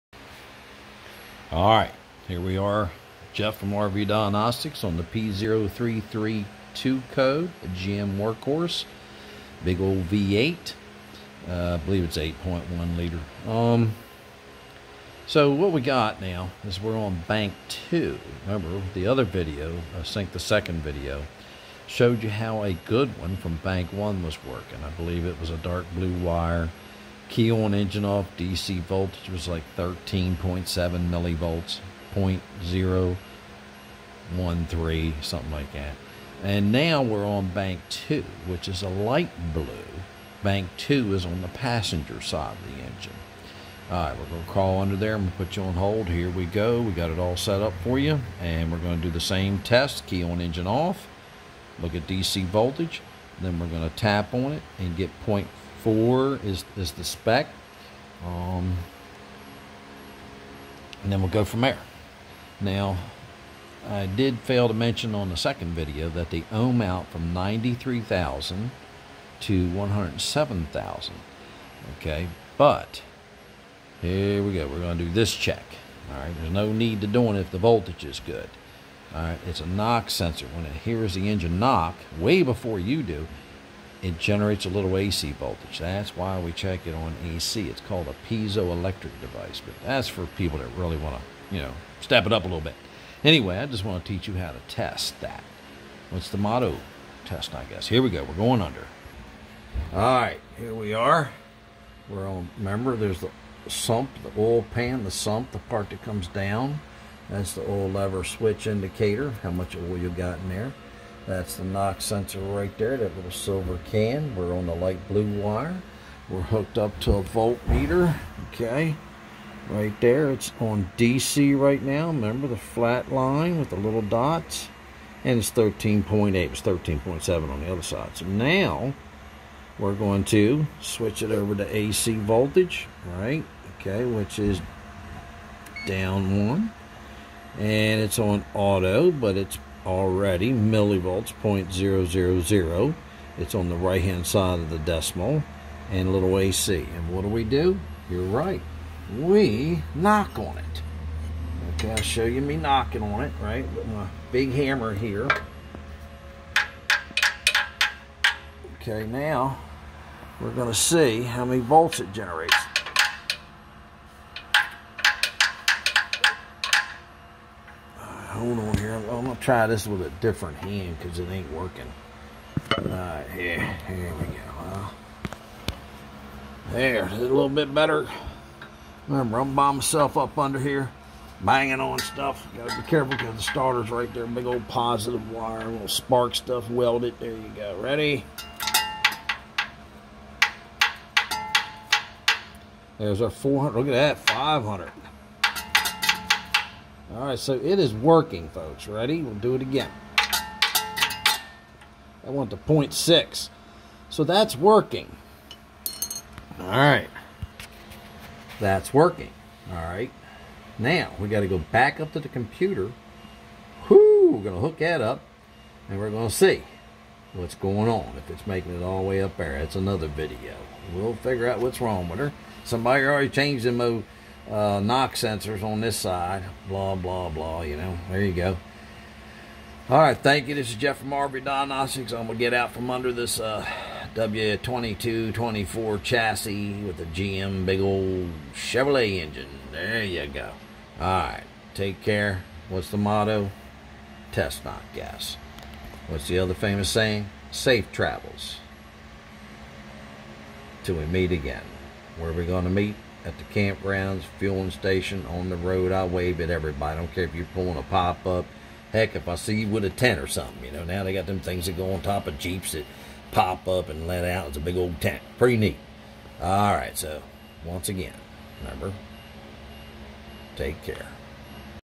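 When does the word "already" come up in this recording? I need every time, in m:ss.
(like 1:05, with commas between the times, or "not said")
2:19, 3:43.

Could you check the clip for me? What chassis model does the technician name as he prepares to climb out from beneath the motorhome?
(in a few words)
W2224.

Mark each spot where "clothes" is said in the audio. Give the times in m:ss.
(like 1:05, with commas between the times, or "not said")
not said.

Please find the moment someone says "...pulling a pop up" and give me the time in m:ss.
4:17.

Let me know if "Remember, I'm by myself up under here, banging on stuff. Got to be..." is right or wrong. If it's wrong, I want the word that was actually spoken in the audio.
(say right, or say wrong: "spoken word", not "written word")
right.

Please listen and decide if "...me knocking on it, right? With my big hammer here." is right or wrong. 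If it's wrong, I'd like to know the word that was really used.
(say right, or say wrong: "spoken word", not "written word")
right.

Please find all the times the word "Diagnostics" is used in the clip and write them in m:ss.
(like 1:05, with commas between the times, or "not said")
0:04, 3:51.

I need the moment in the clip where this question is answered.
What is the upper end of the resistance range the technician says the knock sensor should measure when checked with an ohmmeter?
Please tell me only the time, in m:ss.
1:09.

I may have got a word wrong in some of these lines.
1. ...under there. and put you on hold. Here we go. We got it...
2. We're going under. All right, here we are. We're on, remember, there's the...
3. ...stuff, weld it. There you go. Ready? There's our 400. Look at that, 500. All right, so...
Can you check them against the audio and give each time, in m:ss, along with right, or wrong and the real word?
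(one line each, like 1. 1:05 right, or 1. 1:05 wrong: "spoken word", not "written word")
1. 0:44 right
2. 1:38 right
3. 3:06 right.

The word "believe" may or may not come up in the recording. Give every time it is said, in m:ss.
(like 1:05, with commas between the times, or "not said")
0:11, 0:24.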